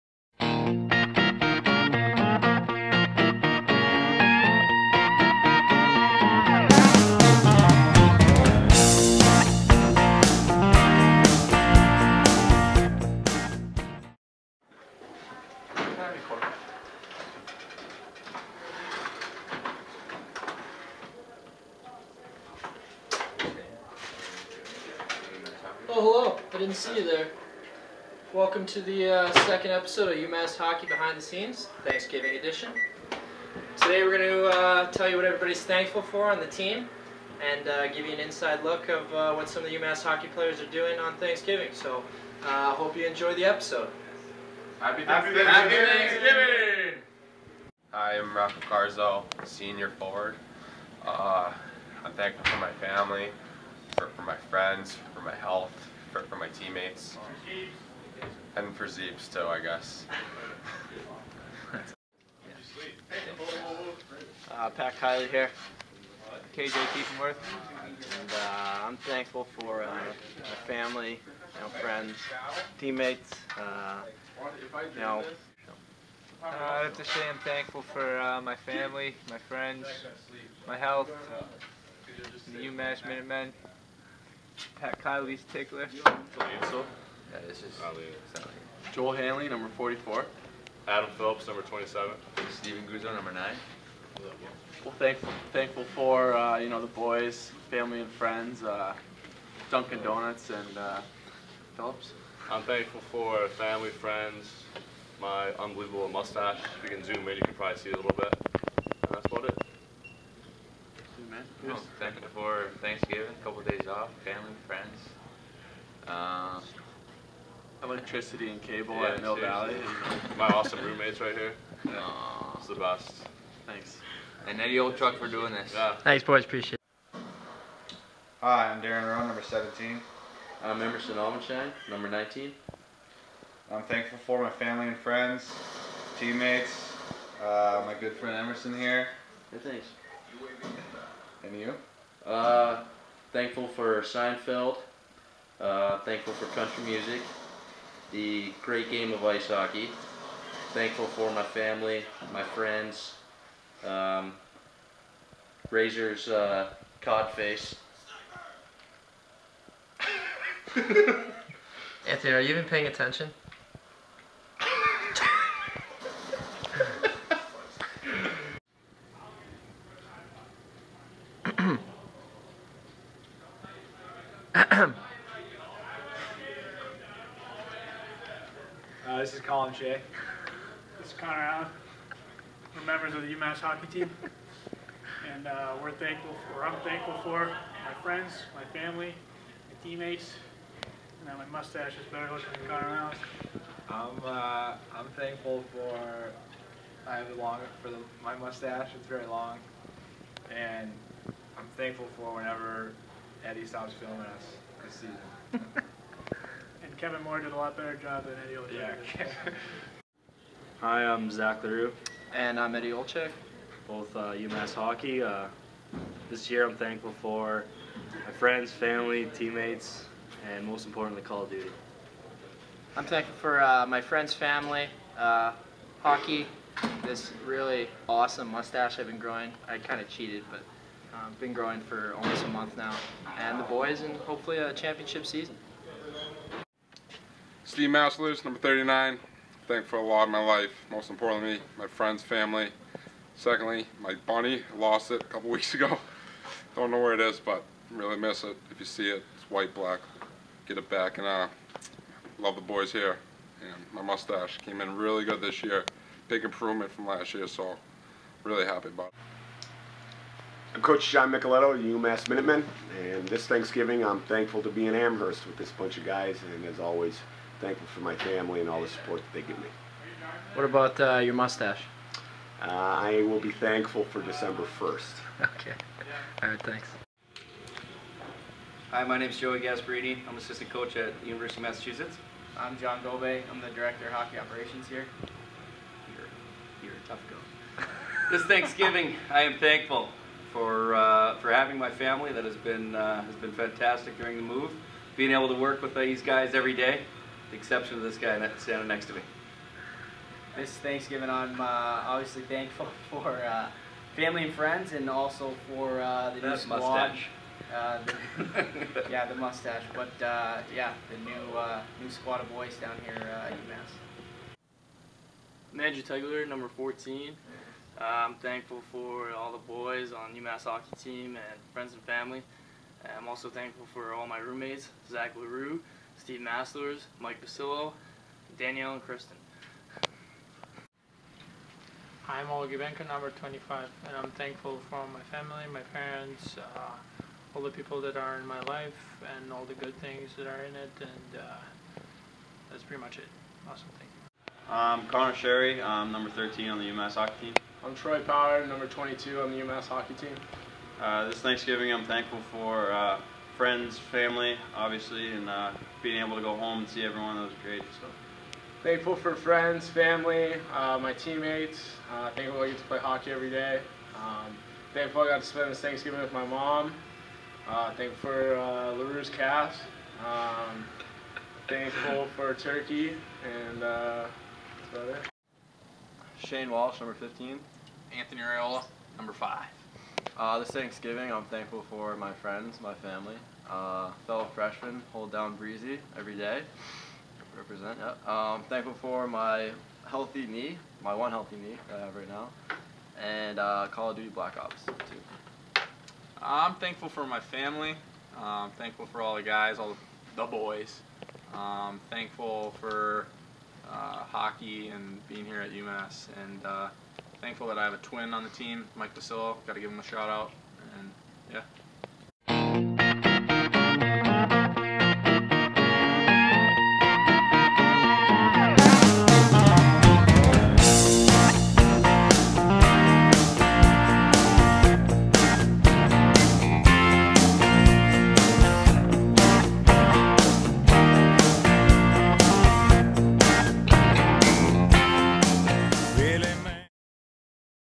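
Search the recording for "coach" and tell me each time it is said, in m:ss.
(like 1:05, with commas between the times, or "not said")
4:20, 4:40, 4:47.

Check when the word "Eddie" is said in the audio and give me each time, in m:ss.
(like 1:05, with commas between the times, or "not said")
2:04, 3:23, 3:28, 3:32.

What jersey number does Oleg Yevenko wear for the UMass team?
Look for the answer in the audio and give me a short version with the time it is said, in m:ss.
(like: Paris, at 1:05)
25, at 5:33.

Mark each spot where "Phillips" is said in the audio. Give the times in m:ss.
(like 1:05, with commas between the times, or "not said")
1:31, 1:41.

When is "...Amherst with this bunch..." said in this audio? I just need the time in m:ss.
4:24.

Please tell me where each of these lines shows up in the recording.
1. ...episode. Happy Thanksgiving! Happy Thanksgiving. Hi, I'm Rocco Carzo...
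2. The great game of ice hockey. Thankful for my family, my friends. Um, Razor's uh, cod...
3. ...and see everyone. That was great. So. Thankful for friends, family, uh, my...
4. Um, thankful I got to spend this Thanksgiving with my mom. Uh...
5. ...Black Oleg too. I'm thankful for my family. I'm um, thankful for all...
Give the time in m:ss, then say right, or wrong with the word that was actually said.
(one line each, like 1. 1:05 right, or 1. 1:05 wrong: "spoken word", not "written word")
1. 0:43 right
2. 2:28 right
3. 5:56 right
4. 6:04 right
5. 6:34 wrong: "Ops", not "Oleg".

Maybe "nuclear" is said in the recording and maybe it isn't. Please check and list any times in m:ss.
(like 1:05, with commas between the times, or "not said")
not said.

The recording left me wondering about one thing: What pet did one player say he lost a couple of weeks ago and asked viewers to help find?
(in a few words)
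bunny.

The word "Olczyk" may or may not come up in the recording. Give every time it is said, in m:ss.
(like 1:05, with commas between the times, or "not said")
2:04, 3:28, 3:32.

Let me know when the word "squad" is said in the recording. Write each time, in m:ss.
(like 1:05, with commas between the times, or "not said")
5:06, 5:12.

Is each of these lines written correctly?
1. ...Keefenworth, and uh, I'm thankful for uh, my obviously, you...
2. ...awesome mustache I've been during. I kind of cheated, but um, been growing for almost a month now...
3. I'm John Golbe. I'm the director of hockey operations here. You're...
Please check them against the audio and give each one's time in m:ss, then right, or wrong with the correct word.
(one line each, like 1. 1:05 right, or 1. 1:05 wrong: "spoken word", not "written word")
1. 1:06 wrong: "family", not "obviously"
2. 3:48 wrong: "growing", not "during"
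3. 4:42 right.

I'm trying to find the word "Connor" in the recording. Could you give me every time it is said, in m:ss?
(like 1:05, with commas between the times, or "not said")
3:01, 3:12, 5:45.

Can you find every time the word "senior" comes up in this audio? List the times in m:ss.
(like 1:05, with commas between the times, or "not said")
0:49.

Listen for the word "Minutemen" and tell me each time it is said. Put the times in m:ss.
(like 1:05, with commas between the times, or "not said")
1:23, 4:22.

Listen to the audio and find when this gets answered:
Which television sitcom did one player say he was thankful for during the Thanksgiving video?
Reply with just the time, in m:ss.
2:24.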